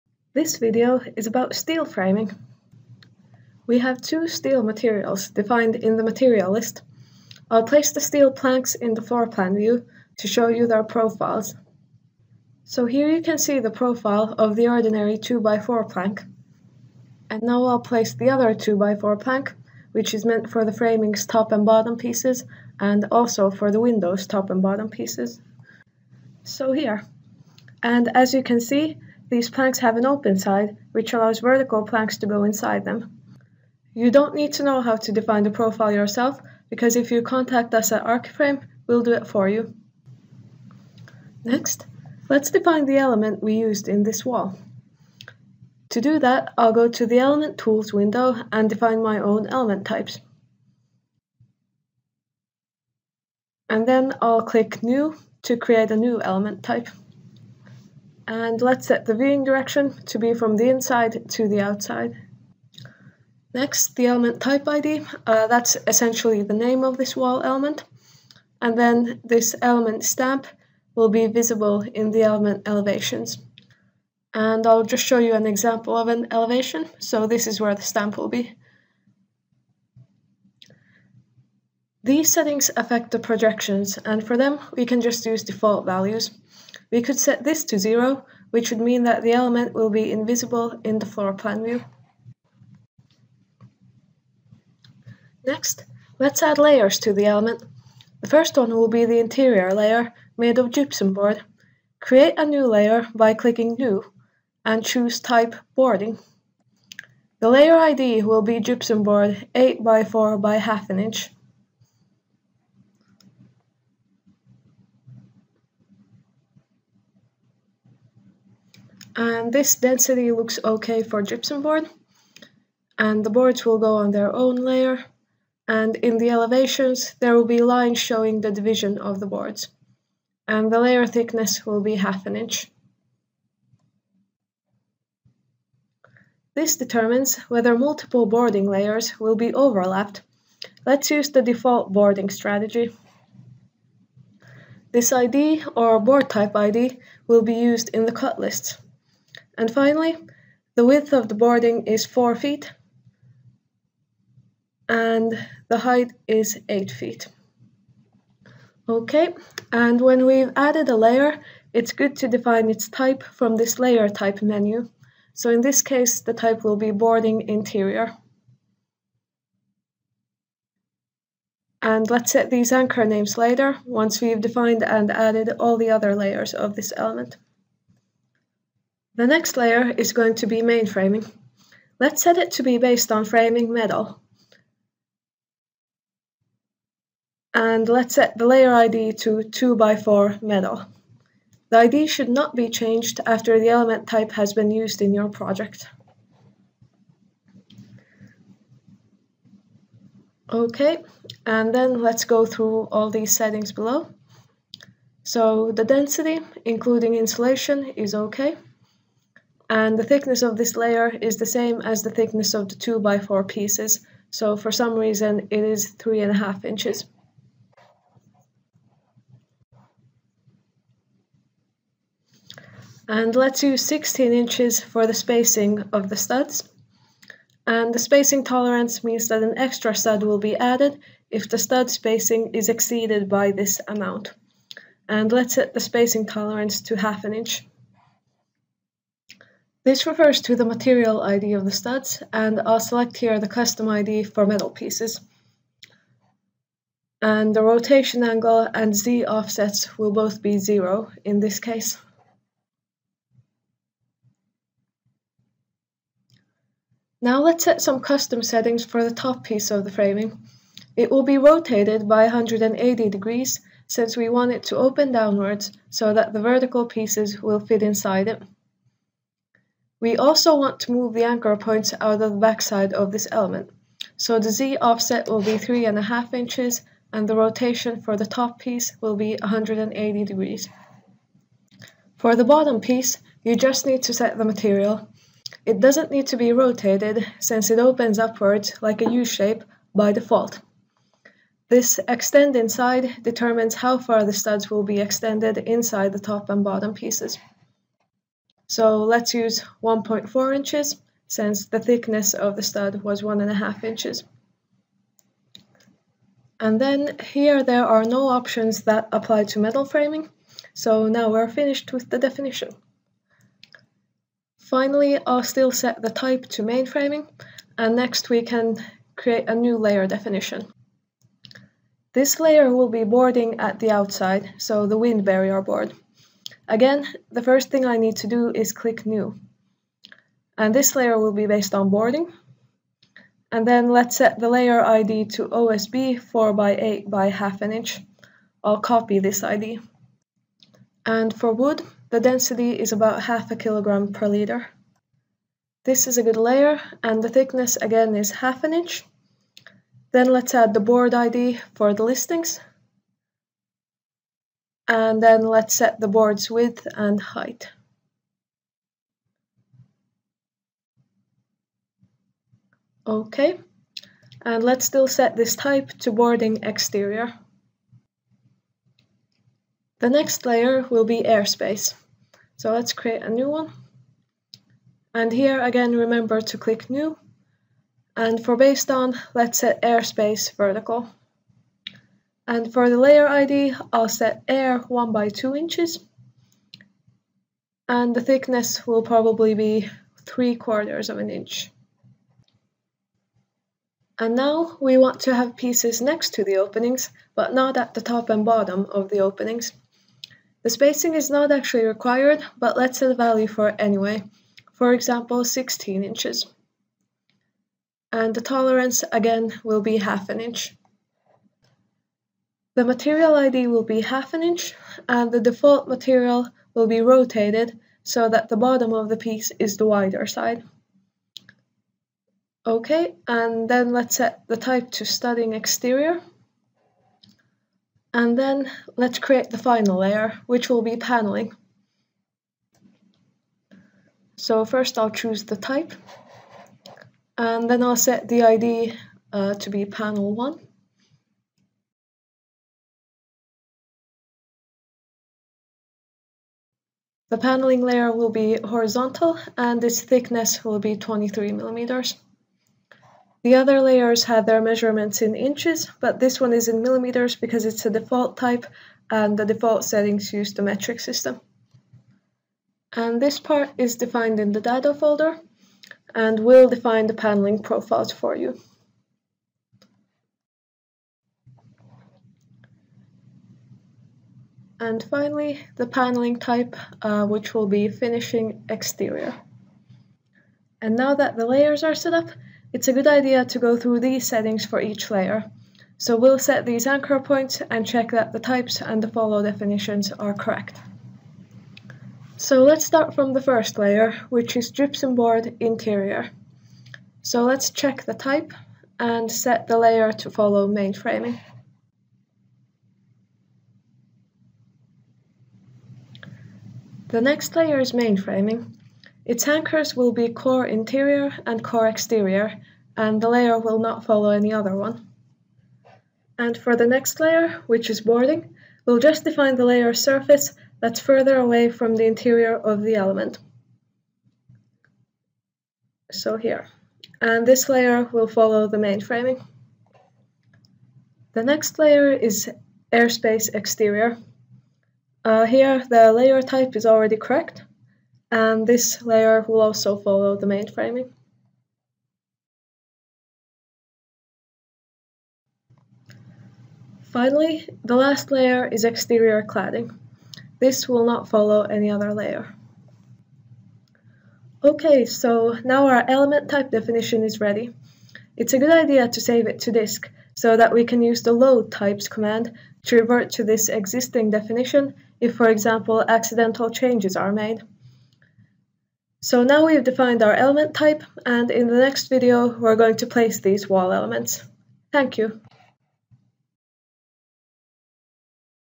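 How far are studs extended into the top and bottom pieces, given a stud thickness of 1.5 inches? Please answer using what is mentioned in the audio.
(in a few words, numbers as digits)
1.4 inches.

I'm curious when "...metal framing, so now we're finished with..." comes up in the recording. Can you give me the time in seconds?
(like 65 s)
309 s.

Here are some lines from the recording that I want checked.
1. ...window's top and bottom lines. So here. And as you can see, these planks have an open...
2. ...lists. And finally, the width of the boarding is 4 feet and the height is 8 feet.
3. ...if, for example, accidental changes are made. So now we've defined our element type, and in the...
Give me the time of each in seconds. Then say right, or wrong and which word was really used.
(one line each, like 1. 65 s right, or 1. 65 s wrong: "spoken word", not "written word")
1. 23 s wrong: "pieces", not "lines"
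2. 148 s right
3. 565 s right.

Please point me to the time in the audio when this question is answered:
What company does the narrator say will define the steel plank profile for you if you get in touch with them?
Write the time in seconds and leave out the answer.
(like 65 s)
38 s.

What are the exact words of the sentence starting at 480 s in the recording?
And now that the layers are set up, it's a good idea to go through these settings for each layer.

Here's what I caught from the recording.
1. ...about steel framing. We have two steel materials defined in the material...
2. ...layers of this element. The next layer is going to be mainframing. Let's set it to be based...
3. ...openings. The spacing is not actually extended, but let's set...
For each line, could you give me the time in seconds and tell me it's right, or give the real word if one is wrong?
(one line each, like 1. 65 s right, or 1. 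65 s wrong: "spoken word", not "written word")
1. 1 s right
2. 176 s right
3. 399 s wrong: "required", not "extended".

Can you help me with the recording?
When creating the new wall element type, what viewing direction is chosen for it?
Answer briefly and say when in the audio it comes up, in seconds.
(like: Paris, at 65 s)
from the inside to the outside, at 60 s.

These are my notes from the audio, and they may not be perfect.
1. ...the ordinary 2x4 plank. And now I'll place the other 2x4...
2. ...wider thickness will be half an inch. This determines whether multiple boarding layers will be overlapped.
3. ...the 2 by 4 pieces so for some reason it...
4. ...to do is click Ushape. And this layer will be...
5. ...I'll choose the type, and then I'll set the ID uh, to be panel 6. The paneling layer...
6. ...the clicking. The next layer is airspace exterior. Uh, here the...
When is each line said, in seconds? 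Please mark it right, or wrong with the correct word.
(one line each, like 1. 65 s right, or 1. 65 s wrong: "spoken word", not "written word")
1. 14 s right
2. 130 s wrong: "layer", not "wider"
3. 212 s right
4. 328 s wrong: "New", not "Ushape"
5. 434 s wrong: "1", not "6"
6. 528 s wrong: "mainframing", not "clicking".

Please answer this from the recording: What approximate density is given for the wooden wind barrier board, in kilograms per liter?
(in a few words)
half a kilogram per liter.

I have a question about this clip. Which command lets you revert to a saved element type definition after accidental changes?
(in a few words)
load types.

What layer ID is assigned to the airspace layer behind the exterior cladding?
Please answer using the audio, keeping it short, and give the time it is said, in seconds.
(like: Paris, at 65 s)
air 1 by 2 inches, at 384 s.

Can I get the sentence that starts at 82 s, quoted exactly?
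These settings affect the projections, and for them, we can just use default values.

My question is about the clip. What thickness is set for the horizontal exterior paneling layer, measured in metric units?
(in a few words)
23 millimeters.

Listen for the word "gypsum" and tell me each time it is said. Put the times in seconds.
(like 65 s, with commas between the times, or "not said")
100 s, 108 s, 121 s, 494 s.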